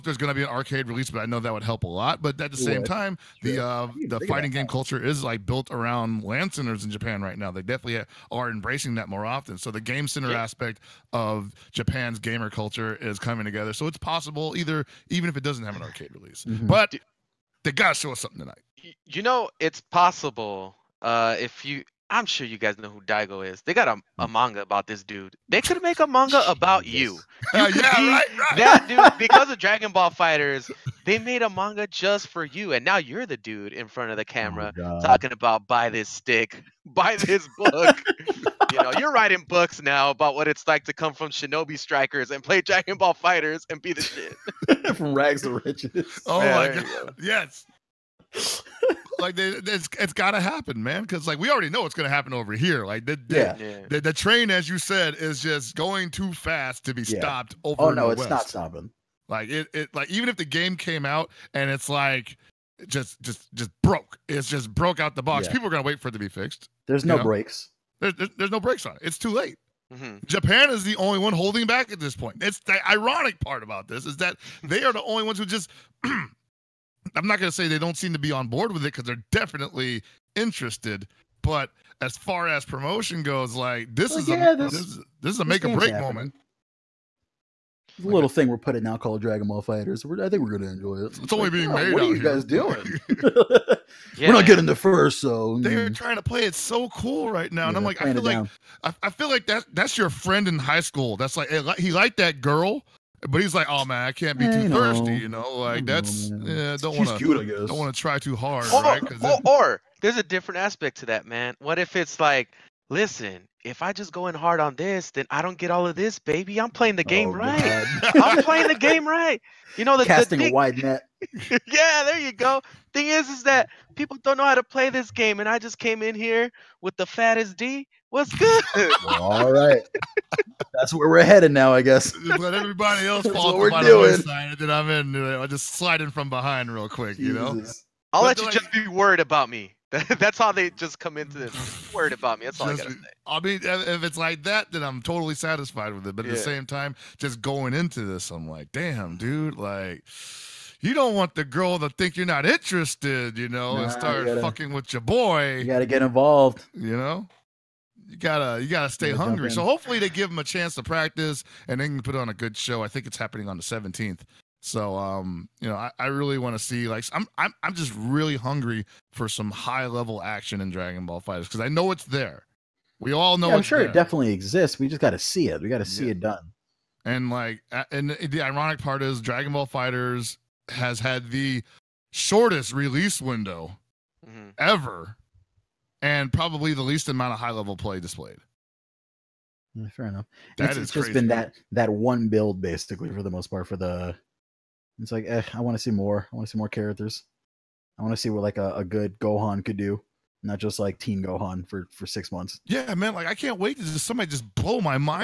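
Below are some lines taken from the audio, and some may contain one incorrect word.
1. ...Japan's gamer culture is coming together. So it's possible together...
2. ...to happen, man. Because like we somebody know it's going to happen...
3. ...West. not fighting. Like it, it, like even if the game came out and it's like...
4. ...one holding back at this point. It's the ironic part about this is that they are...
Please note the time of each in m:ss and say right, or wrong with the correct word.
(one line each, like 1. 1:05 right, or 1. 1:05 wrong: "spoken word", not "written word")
1. 0:11 wrong: "either", not "together"
2. 0:50 wrong: "already", not "somebody"
3. 0:58 wrong: "stopping", not "fighting"
4. 1:11 right.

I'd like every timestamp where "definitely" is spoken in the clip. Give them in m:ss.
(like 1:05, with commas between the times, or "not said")
0:07, 1:19, 2:53.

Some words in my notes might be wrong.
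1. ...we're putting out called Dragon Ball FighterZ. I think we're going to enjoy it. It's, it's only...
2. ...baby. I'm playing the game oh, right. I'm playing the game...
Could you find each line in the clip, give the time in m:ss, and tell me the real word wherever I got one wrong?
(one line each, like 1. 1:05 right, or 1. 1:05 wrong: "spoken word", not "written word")
1. 1:28 right
2. 1:56 right.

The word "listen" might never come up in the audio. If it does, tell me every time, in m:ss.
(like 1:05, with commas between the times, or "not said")
1:52.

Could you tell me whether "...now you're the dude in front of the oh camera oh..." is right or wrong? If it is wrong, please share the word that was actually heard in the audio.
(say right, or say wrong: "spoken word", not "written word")
right.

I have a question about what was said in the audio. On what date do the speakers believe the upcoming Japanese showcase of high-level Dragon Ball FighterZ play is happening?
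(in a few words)
the 17th.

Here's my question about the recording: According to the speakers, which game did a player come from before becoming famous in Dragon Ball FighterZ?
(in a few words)
Shinobi Strikers.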